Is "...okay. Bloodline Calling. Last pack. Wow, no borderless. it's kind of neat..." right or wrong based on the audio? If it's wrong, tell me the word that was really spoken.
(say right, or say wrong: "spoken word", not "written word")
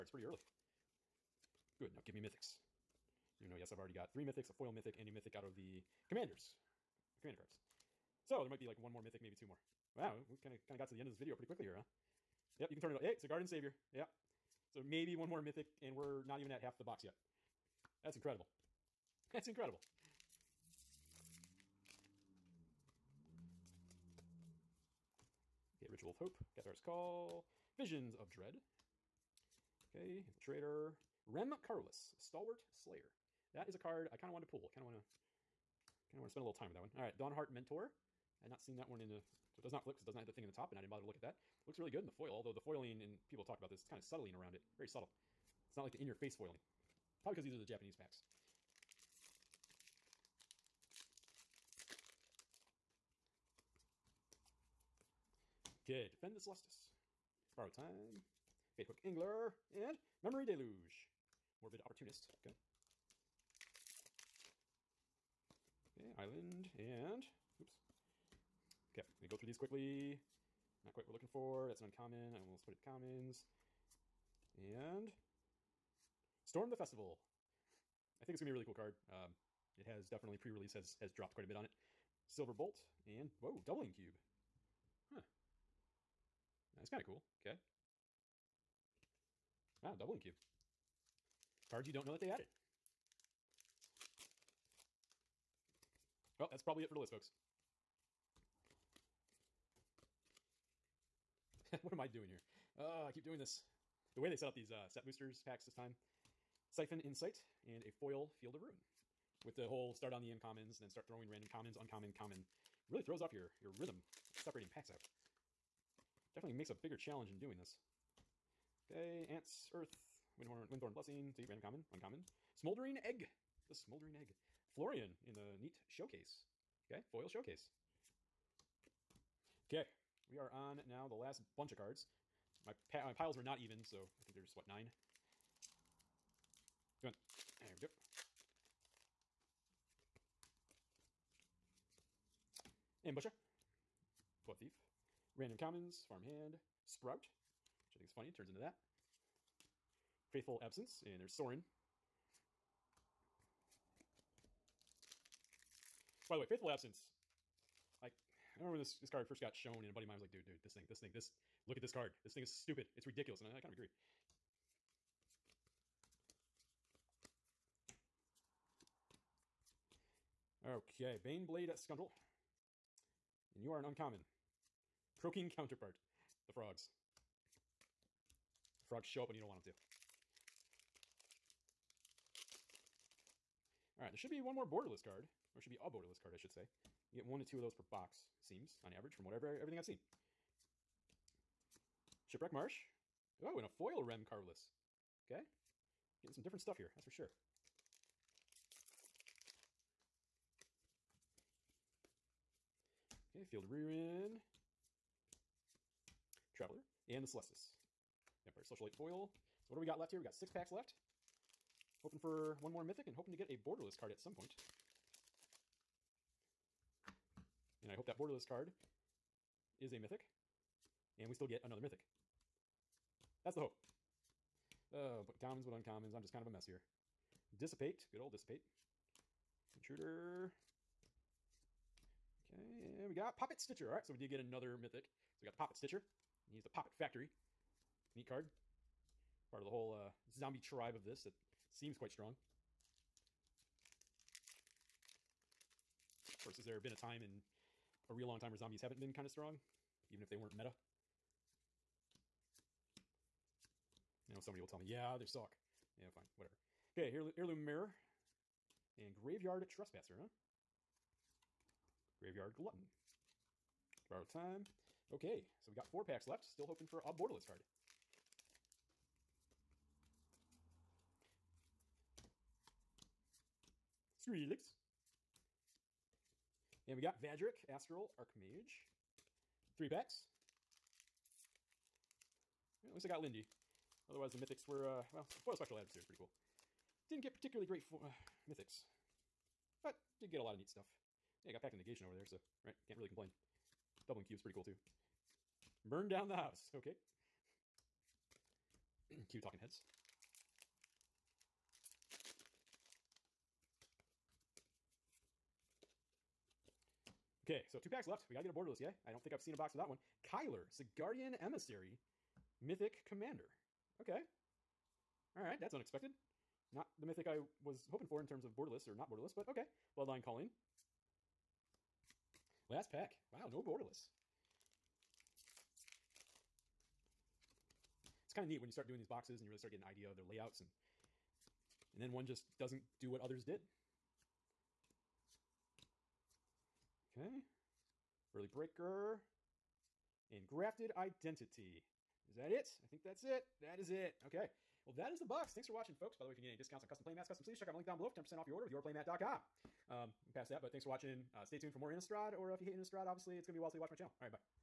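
right.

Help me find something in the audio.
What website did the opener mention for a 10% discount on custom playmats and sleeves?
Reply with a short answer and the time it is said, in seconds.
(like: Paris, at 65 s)
yourplaymat.com, at 348 s.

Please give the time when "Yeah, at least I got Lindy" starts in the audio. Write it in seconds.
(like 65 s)
282 s.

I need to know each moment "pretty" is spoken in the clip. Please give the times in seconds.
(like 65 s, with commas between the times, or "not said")
0 s, 11 s, 286 s, 294 s.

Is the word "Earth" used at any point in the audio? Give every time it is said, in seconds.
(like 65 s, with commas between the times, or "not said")
119 s.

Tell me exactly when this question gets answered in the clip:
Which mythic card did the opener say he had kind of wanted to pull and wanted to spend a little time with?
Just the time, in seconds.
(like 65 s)
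31 s.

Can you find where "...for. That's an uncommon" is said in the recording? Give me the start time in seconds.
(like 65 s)
71 s.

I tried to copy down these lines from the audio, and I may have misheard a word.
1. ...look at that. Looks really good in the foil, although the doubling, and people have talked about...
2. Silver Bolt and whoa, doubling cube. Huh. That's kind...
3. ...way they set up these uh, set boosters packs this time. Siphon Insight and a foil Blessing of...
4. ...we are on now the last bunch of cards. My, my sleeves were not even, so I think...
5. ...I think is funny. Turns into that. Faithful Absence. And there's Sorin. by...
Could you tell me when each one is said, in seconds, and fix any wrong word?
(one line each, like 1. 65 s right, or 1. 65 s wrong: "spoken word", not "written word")
1. 41 s wrong: "foiling", not "doubling"
2. 82 s right
3. 104 s wrong: "Field", not "Blessing"
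4. 130 s wrong: "piles", not "sleeves"
5. 147 s right.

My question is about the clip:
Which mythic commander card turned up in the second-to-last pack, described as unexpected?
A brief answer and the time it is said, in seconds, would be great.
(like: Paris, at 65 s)
Kyler, Guardian Emissary, at 310 s.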